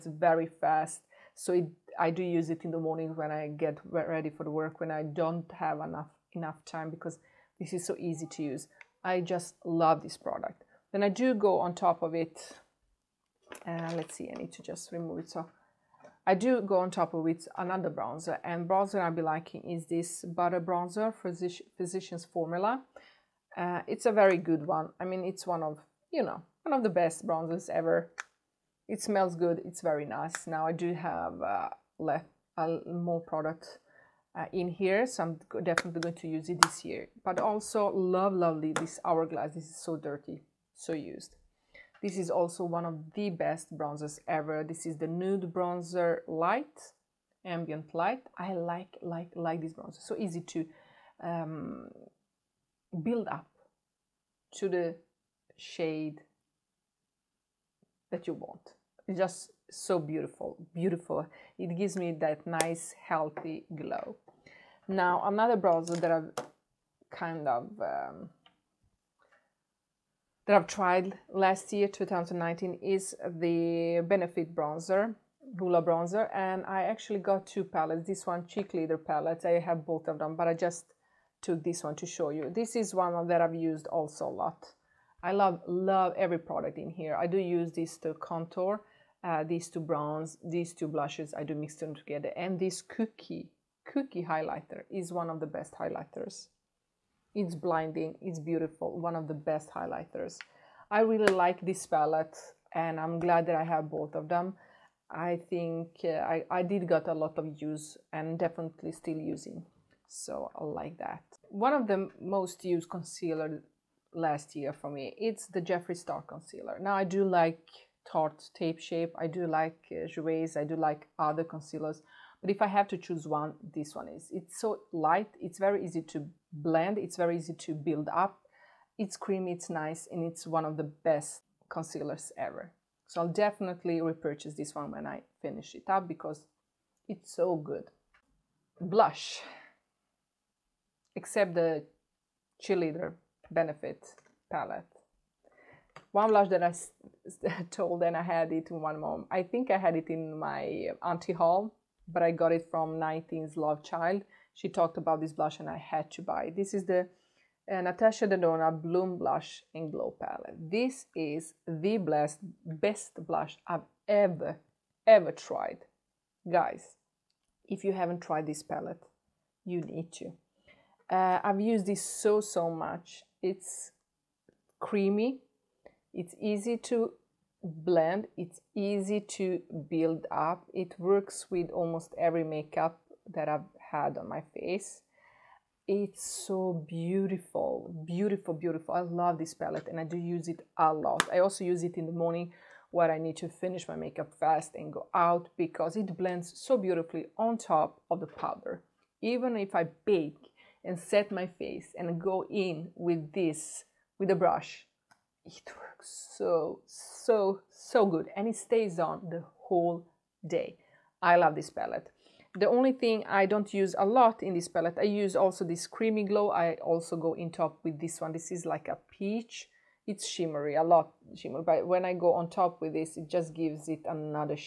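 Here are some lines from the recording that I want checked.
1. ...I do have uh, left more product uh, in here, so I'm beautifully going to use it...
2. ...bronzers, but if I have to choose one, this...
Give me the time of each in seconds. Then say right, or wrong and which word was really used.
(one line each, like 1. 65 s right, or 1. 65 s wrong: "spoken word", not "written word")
1. 30 s wrong: "definitely", not "beautifully"
2. 121 s wrong: "concealers", not "bronzers".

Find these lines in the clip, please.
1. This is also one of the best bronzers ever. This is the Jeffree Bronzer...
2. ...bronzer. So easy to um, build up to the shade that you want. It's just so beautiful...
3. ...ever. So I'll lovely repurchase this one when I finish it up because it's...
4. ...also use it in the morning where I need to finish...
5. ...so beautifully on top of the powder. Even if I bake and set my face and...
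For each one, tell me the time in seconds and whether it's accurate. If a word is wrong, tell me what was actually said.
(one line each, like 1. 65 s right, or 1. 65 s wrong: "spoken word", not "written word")
1. 42 s wrong: "Nude", not "Jeffree"
2. 49 s right
3. 132 s wrong: "definitely", not "lovely"
4. 191 s right
5. 196 s right.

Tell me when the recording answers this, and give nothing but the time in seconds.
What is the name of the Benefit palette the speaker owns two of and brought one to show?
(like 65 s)
78 s.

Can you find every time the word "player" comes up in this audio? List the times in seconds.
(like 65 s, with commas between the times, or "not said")
not said.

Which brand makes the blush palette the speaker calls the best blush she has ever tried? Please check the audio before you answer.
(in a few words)
Natasha Denona.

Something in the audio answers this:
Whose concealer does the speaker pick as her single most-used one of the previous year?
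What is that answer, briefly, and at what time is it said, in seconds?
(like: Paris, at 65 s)
Jeffree Star, at 115 s.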